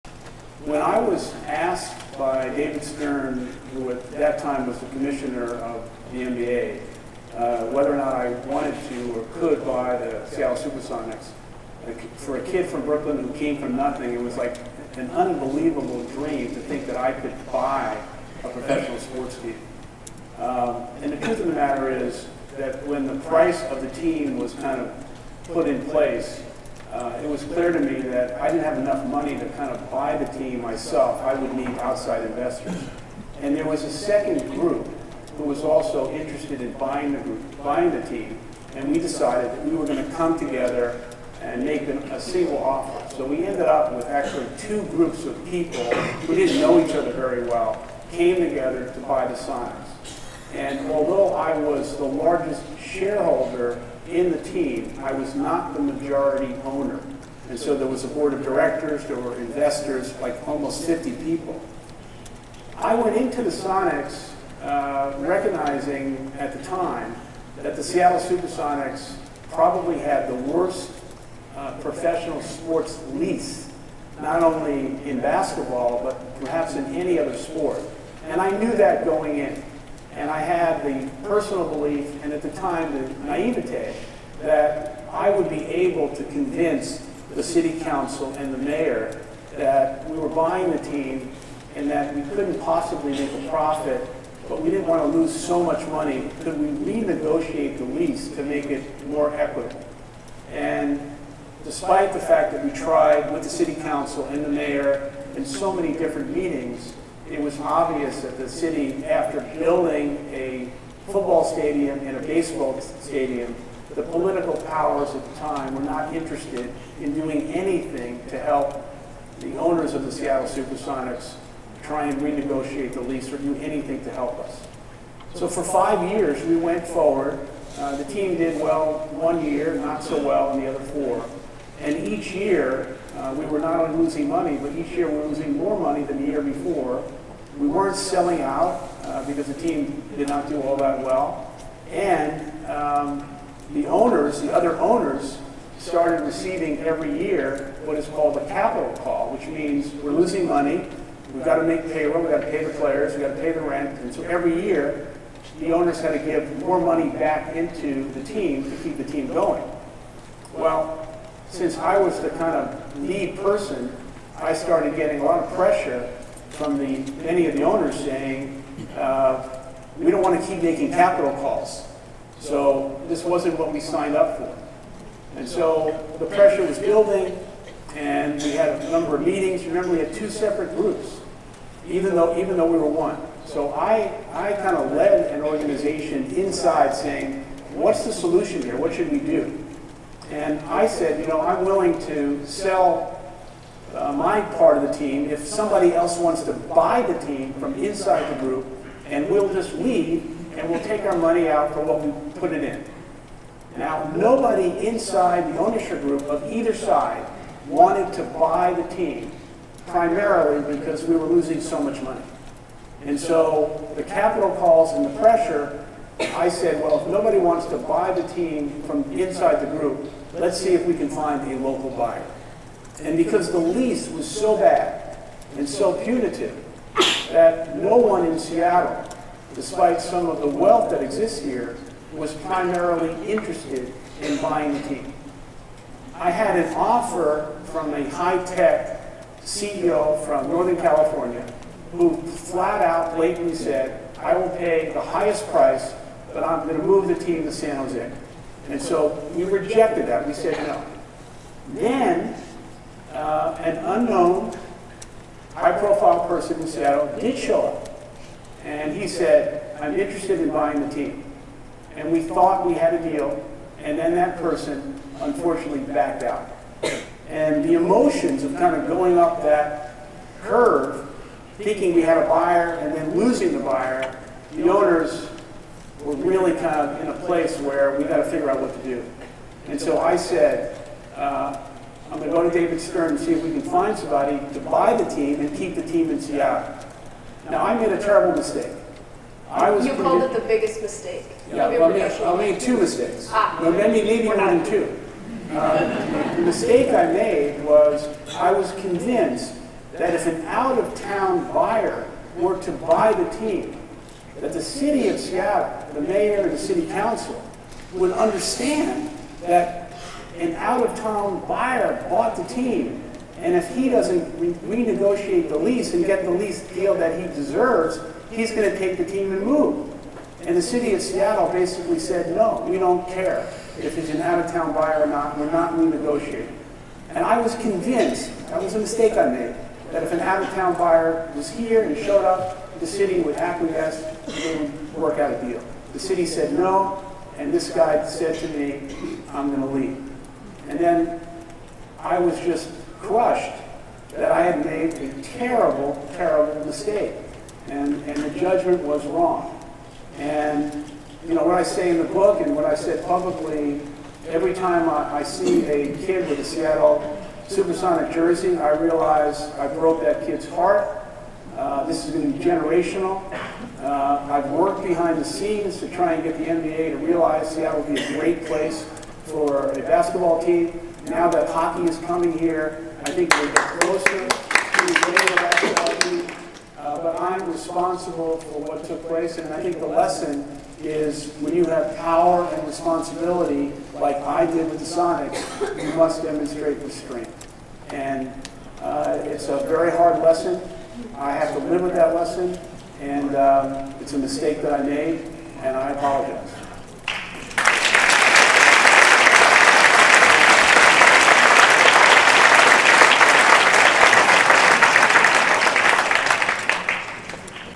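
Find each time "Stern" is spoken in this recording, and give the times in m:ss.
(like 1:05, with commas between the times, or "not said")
0:02, 4:42.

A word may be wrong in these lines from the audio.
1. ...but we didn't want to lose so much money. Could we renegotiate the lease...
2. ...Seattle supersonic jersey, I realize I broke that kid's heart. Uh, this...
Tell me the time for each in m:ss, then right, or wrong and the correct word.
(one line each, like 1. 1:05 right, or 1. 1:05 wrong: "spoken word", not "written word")
1. 1:34 right
2. 5:56 right.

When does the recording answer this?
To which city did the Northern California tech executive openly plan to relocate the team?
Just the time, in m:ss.
4:07.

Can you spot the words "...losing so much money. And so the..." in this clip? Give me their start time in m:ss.
3:31.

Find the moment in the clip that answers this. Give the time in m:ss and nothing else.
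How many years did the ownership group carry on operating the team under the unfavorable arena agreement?
2:05.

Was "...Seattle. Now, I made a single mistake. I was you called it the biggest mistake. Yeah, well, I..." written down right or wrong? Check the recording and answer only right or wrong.
wrong.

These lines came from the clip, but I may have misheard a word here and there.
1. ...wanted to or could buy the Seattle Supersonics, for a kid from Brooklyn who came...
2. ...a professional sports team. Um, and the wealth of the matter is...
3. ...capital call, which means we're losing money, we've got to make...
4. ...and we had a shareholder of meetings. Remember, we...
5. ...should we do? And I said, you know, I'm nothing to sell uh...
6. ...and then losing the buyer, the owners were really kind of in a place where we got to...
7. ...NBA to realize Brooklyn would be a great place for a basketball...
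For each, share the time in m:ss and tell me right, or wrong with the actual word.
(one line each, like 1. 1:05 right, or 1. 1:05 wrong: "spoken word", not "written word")
1. 0:08 right
2. 0:18 wrong: "truth", not "wealth"
3. 2:28 right
4. 2:57 wrong: "number", not "shareholder"
5. 3:08 wrong: "willing", not "nothing"
6. 4:32 right
7. 6:06 wrong: "Seattle", not "Brooklyn".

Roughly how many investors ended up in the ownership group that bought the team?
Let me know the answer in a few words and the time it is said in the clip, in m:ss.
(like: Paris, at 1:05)
50, at 1:00.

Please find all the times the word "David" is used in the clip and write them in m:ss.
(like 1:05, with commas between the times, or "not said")
0:02, 4:42.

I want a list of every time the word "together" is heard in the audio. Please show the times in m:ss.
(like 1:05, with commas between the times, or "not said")
0:40, 0:48.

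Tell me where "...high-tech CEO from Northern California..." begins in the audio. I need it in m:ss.
3:58.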